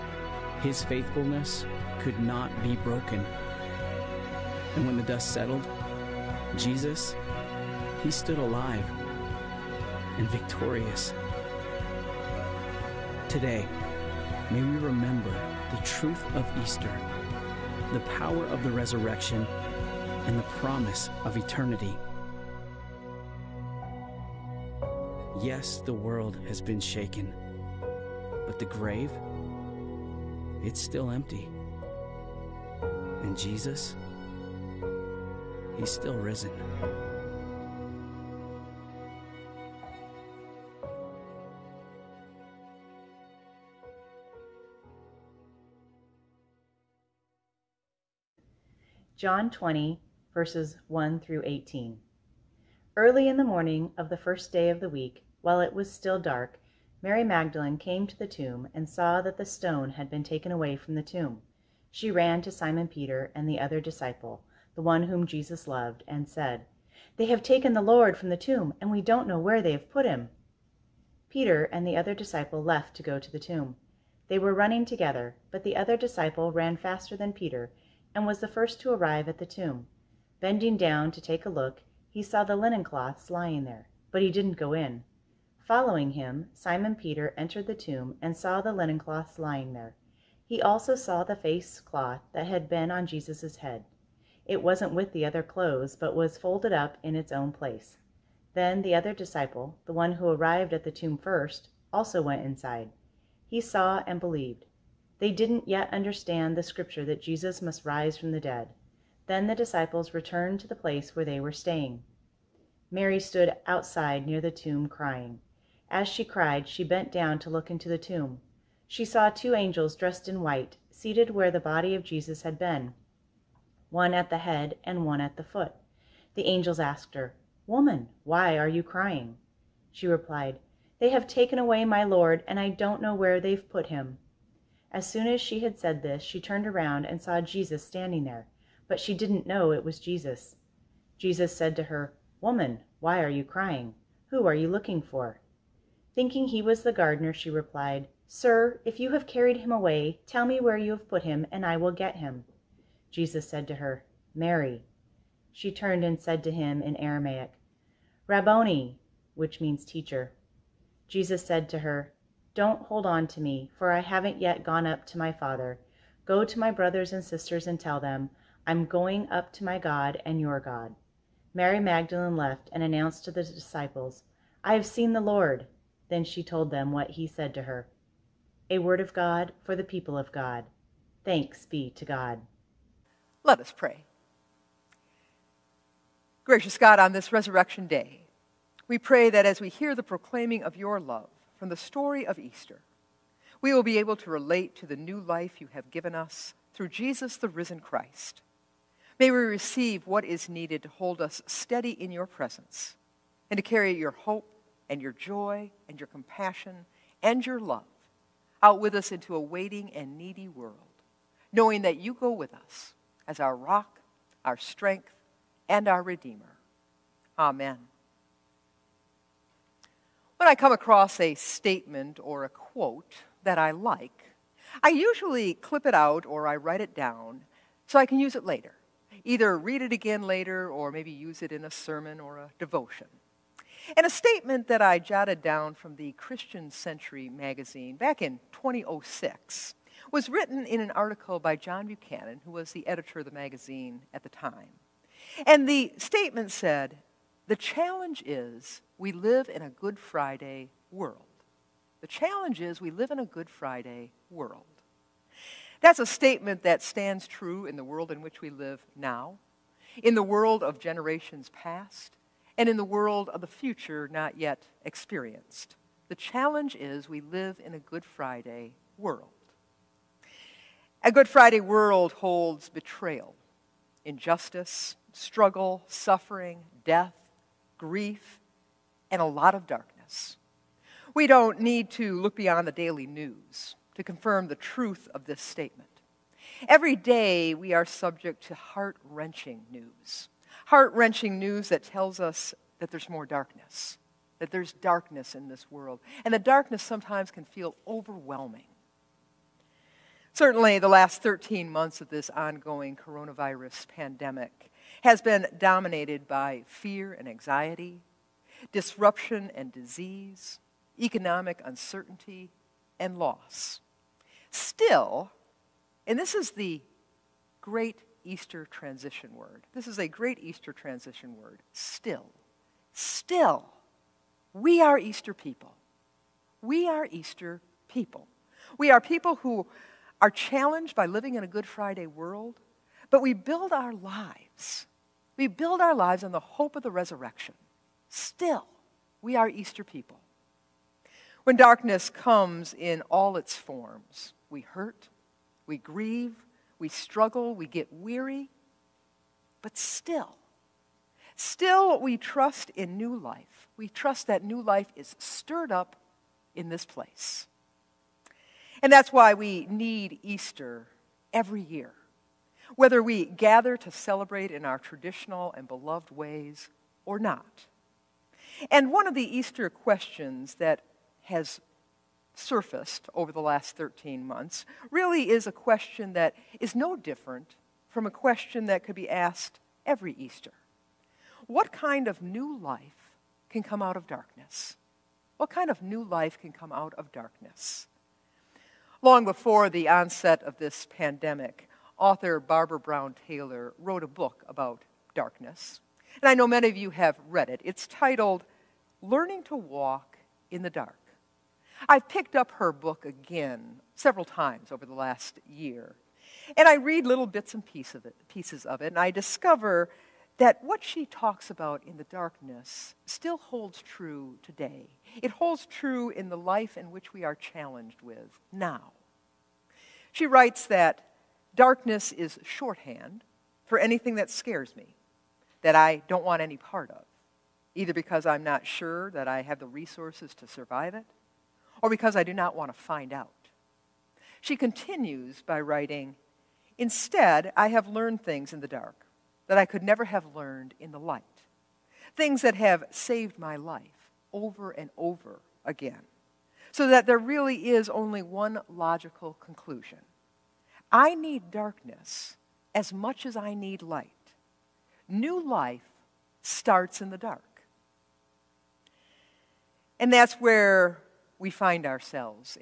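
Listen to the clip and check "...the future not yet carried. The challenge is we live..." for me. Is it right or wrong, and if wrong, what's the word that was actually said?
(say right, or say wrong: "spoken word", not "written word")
wrong: "experienced", not "carried".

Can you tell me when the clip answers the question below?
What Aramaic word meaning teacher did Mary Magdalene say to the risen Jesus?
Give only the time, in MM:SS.
02:38.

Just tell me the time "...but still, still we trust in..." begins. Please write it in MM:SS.
05:49.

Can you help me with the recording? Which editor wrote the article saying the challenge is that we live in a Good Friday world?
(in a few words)
John Buchanan.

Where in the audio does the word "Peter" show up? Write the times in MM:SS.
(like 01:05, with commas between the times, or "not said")
01:02, 01:11, 01:17, 01:26.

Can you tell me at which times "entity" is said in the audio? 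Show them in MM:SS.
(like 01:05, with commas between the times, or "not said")
not said.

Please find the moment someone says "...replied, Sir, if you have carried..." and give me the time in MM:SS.
02:27.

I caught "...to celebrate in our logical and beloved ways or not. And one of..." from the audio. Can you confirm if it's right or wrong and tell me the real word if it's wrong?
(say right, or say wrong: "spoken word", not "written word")
wrong: "traditional", not "logical".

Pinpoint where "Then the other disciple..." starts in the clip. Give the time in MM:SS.
01:38.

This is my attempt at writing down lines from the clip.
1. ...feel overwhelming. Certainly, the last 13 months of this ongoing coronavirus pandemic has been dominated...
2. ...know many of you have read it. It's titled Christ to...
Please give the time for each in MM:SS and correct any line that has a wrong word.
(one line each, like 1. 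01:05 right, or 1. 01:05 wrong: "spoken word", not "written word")
1. 04:57 right
2. 06:36 wrong: "Learning", not "Christ".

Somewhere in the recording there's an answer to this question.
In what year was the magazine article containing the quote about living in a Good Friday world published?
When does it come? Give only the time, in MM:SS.
03:58.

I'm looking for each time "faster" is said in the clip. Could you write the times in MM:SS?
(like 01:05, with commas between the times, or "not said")
01:16.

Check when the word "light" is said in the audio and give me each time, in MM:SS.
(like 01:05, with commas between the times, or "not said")
07:20, 07:33.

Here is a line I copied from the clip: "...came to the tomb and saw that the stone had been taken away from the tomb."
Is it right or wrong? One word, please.
right.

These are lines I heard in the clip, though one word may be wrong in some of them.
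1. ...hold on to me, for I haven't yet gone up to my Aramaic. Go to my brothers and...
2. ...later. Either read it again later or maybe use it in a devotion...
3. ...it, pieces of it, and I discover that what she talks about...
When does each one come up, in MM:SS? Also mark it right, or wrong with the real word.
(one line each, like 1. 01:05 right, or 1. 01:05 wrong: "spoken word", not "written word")
1. 02:42 wrong: "Father", not "Aramaic"
2. 03:48 wrong: "sermon", not "devotion"
3. 06:48 right.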